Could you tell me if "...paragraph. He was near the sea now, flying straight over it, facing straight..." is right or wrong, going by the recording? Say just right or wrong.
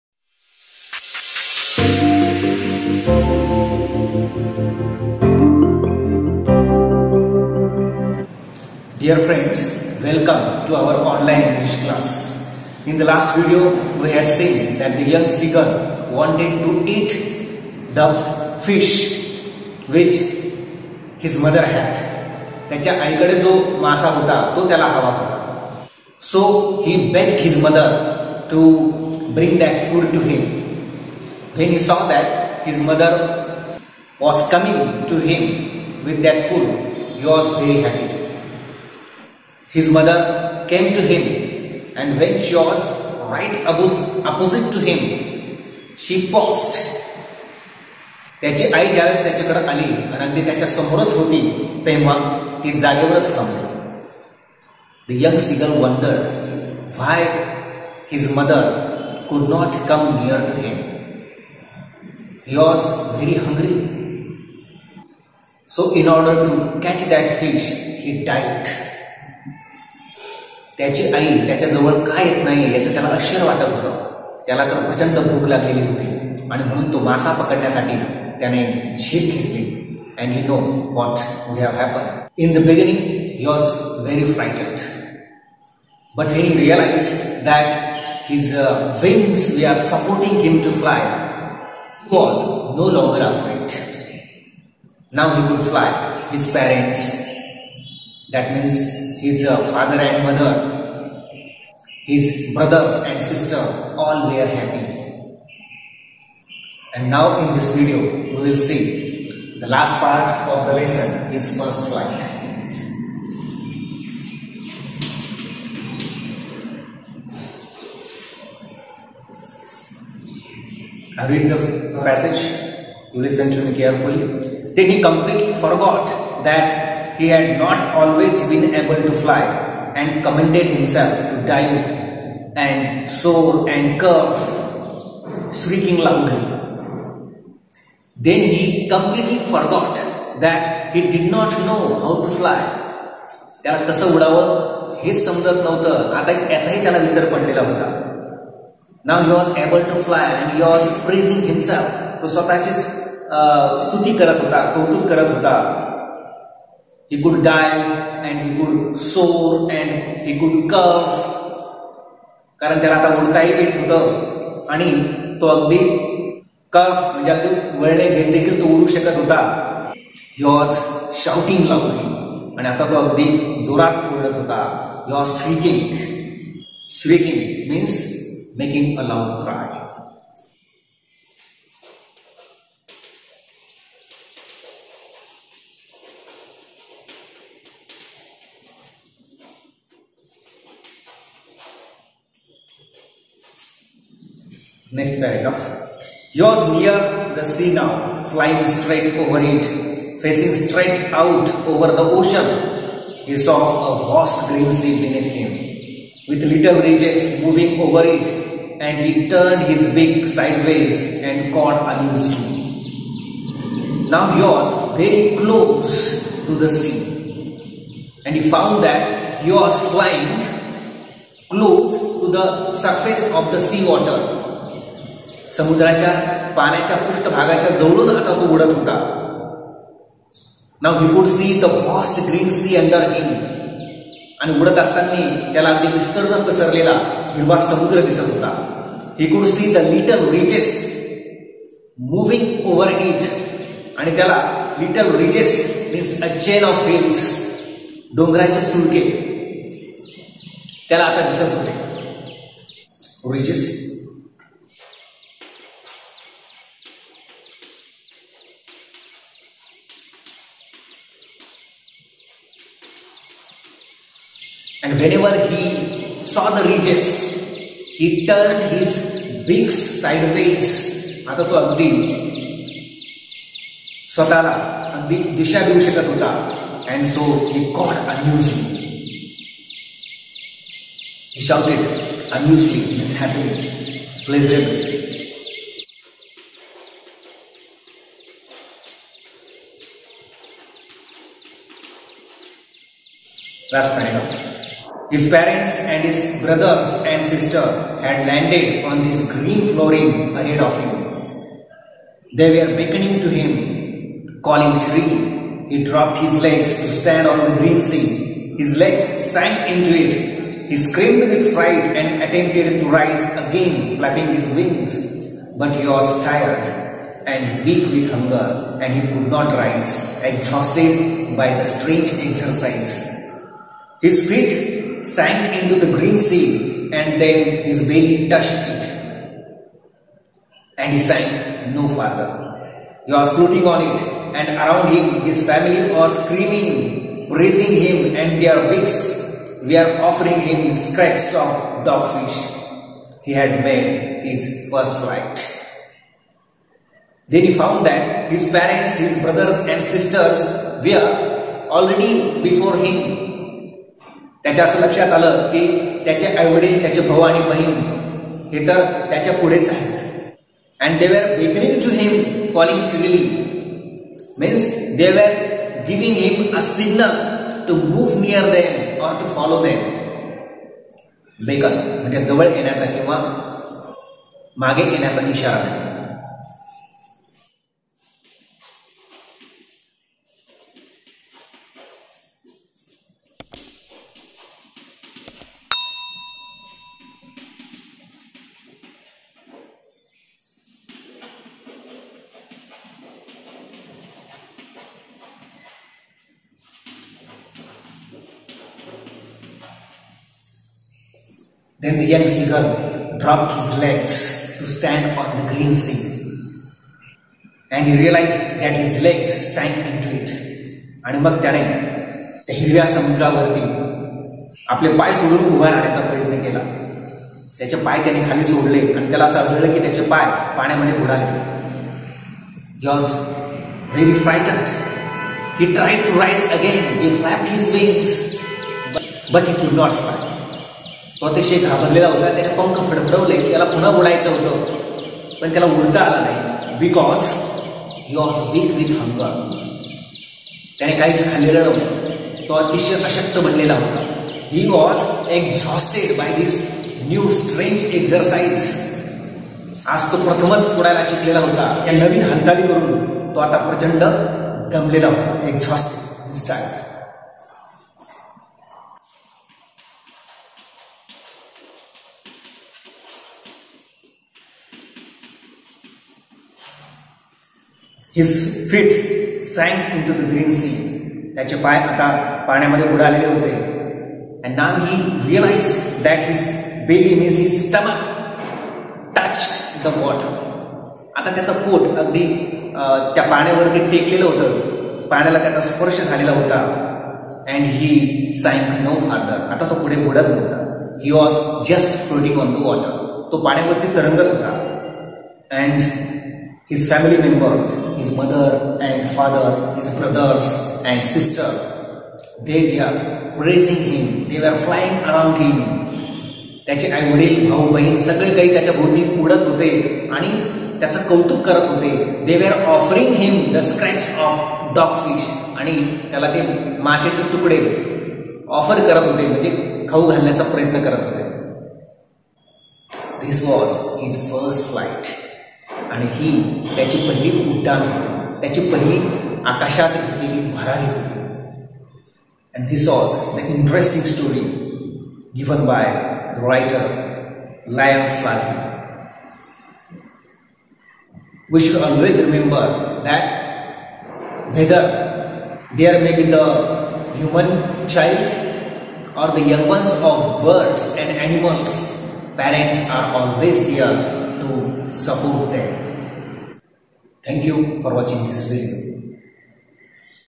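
right.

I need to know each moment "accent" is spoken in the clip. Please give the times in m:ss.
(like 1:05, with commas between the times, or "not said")
not said.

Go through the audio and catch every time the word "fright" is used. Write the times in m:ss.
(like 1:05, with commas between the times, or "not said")
5:11.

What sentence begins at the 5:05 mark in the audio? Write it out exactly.
He dropped his legs to stand on the green sea.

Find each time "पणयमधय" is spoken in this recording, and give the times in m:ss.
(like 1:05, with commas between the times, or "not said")
7:00, 7:52.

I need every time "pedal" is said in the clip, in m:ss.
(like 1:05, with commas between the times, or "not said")
not said.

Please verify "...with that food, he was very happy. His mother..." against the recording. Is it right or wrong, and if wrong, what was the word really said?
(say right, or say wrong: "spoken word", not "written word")
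right.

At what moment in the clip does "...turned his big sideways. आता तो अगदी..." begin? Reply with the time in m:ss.
4:28.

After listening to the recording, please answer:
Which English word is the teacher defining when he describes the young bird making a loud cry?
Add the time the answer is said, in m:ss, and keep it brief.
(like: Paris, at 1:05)
shrieking, at 2:56.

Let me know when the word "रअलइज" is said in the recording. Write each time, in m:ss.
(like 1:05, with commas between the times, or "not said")
1:26, 7:55.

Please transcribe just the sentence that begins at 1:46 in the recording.
And now in this video we will see the last part of the lesson His First Flight.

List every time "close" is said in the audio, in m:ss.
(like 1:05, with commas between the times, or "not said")
3:35, 3:41.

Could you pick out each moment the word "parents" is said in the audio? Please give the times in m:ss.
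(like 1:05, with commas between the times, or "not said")
4:55, 5:48, 9:12.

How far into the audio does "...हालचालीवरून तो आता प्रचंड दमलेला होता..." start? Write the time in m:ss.
7:32.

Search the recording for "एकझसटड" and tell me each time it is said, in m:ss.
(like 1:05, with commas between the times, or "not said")
7:25, 7:35.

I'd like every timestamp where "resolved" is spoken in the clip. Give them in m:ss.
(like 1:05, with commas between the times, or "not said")
not said.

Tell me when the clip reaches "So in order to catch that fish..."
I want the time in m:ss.
1:05.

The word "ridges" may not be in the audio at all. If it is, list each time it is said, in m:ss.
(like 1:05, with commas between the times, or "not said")
3:26, 4:26.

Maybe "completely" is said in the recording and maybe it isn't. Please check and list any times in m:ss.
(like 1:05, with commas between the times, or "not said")
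2:05, 2:18.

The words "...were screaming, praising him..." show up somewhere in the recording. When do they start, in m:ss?
5:35.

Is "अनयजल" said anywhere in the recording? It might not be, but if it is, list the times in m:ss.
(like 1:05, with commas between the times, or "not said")
4:38, 4:42.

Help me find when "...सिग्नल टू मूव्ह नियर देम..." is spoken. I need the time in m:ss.
6:06.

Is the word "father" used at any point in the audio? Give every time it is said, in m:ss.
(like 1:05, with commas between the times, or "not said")
1:39, 8:19.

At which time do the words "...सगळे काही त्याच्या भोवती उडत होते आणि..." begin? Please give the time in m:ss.
8:28.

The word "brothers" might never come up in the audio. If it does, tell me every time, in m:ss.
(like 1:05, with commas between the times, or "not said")
1:42, 4:56, 5:49, 8:19.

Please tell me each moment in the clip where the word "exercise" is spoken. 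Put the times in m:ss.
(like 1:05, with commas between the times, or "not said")
5:22.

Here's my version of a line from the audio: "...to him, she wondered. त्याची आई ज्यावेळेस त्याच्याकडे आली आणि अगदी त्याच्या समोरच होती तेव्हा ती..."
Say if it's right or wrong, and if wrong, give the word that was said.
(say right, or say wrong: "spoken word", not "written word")
wrong: "paused", not "wondered".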